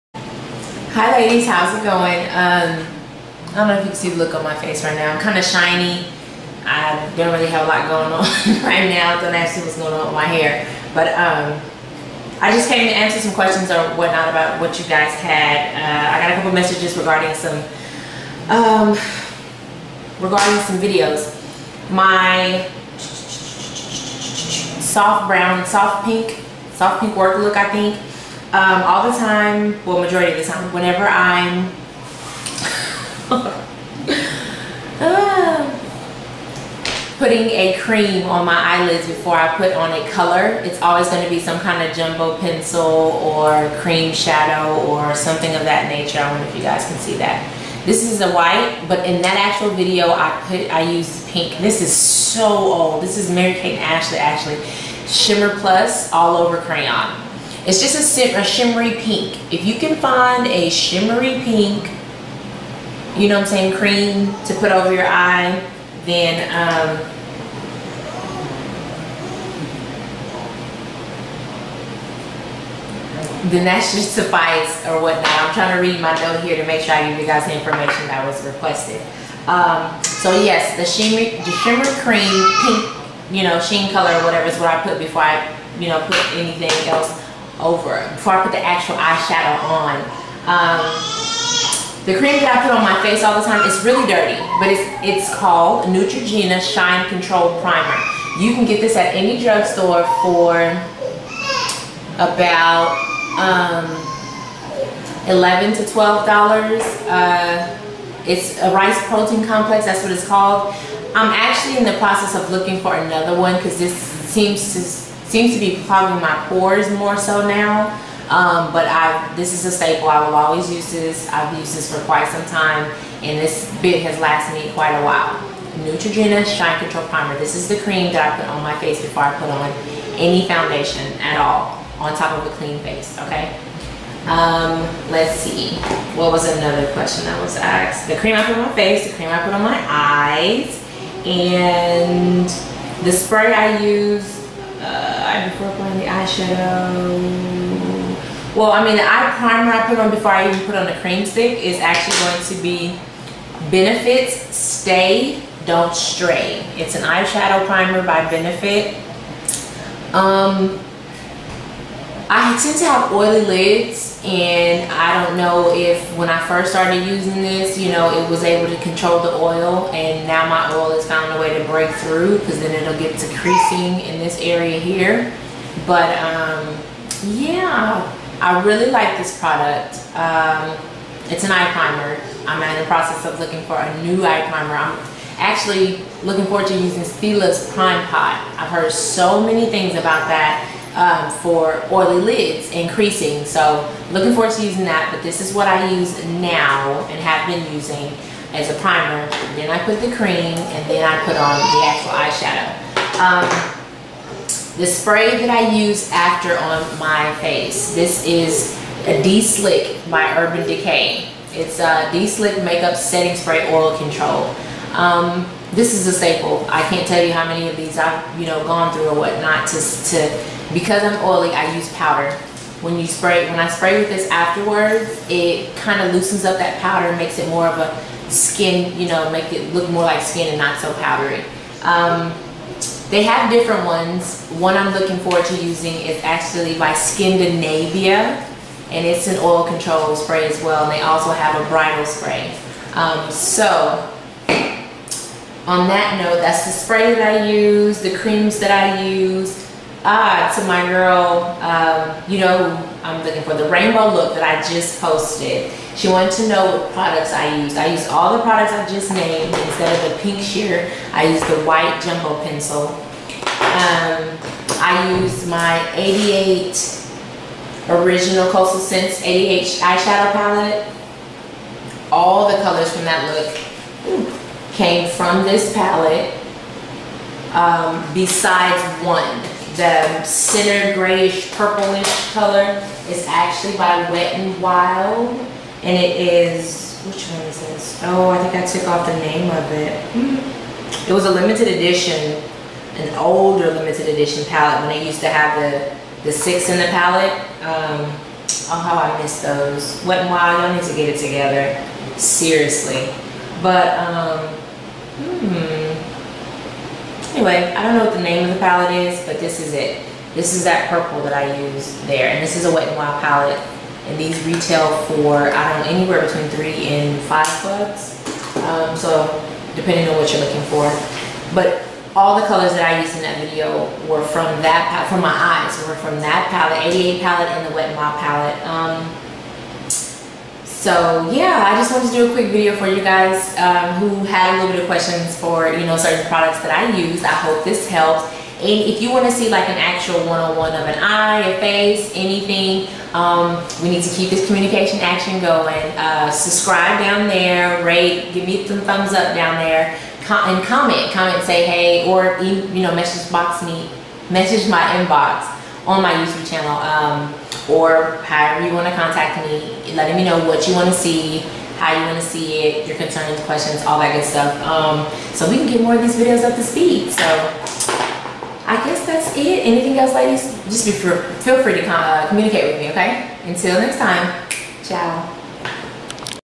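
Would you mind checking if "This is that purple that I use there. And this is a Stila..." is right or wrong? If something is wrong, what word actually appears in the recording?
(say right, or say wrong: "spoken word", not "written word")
wrong: "Wet", not "Stila".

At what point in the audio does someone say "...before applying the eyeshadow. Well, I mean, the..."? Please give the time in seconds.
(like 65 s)
145 s.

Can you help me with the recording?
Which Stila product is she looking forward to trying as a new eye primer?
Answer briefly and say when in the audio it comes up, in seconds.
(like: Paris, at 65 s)
Prime Pot, at 187 s.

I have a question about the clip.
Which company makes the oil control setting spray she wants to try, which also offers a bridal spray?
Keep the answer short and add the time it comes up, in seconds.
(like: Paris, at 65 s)
Skindinavia, at 236 s.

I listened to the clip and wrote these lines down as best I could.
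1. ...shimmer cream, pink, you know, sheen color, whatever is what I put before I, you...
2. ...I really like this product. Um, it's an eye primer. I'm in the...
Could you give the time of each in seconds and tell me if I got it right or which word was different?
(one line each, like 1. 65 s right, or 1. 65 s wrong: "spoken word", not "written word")
1. 81 s right
2. 178 s right.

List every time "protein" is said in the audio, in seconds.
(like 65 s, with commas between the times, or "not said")
109 s.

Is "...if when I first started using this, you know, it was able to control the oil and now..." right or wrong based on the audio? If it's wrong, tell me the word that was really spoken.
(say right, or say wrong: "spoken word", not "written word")
right.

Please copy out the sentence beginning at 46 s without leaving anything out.
I wonder if you guys can see that.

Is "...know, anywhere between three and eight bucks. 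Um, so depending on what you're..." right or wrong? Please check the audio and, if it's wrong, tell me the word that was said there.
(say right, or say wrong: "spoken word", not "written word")
wrong: "five", not "eight".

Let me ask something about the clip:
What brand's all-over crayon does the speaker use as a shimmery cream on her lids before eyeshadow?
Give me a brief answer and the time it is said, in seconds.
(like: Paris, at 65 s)
Mary Kate Ashley, at 53 s.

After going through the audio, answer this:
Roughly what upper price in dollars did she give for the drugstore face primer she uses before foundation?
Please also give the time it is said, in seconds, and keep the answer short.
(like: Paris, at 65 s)
$12, at 105 s.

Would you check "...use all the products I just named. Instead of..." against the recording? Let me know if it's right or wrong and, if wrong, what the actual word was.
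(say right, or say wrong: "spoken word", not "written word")
right.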